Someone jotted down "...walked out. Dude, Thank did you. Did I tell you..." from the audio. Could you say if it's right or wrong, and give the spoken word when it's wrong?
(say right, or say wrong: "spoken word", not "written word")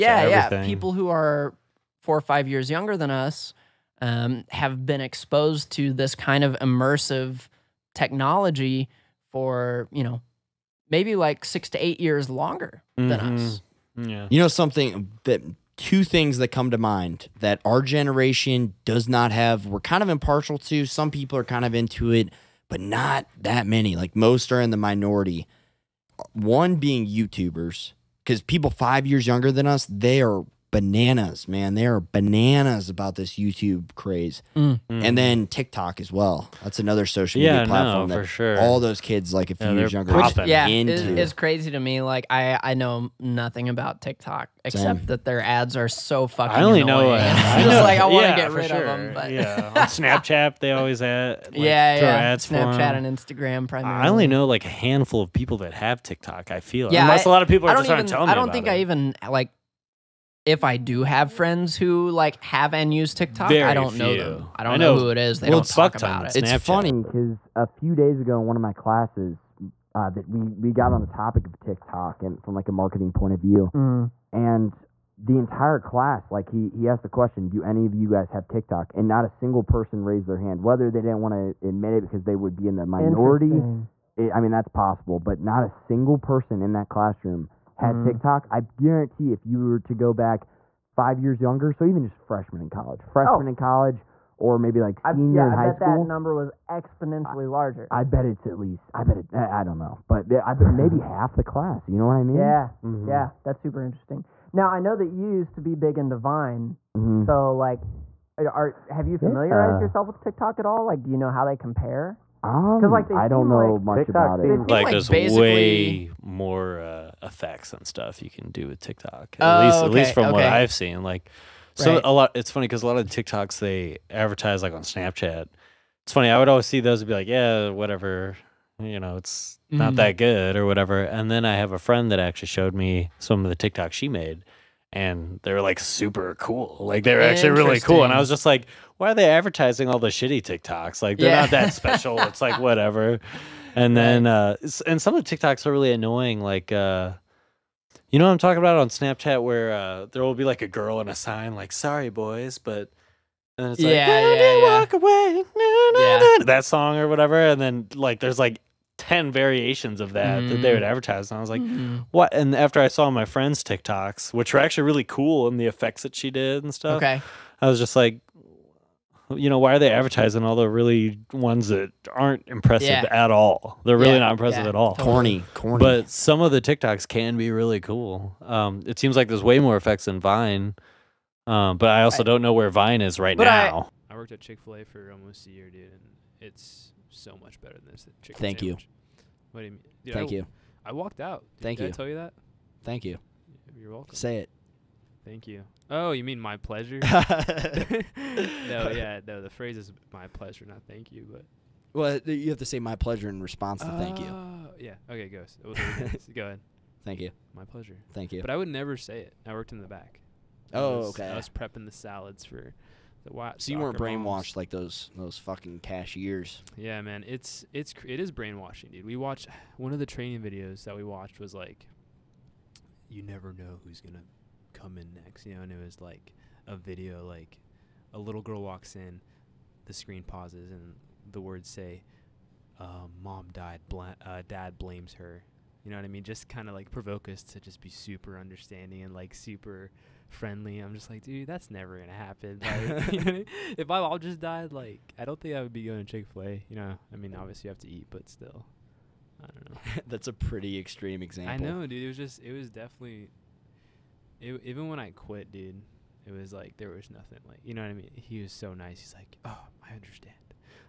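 right.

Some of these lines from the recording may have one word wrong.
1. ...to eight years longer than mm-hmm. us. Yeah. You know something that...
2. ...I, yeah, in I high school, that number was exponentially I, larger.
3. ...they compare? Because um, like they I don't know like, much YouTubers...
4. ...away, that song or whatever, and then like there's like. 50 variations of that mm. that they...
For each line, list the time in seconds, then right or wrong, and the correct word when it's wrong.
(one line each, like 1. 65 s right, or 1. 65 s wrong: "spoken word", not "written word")
1. 11 s right
2. 95 s right
3. 111 s wrong: "TikTok", not "YouTubers"
4. 154 s wrong: "10", not "50".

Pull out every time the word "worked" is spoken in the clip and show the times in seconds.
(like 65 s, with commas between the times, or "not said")
184 s, 209 s.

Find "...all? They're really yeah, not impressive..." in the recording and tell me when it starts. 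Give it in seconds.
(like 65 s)
173 s.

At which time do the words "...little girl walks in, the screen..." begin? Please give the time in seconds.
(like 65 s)
228 s.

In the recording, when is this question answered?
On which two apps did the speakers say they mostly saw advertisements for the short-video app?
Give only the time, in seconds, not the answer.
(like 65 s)
52 s.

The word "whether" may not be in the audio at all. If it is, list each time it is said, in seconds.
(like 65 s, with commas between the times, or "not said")
80 s.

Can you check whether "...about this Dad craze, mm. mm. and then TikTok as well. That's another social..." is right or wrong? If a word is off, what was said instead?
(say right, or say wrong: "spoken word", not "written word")
wrong: "YouTube", not "Dad".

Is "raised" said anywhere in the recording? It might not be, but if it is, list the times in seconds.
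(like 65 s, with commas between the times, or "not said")
80 s.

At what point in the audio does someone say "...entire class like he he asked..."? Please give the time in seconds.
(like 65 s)
75 s.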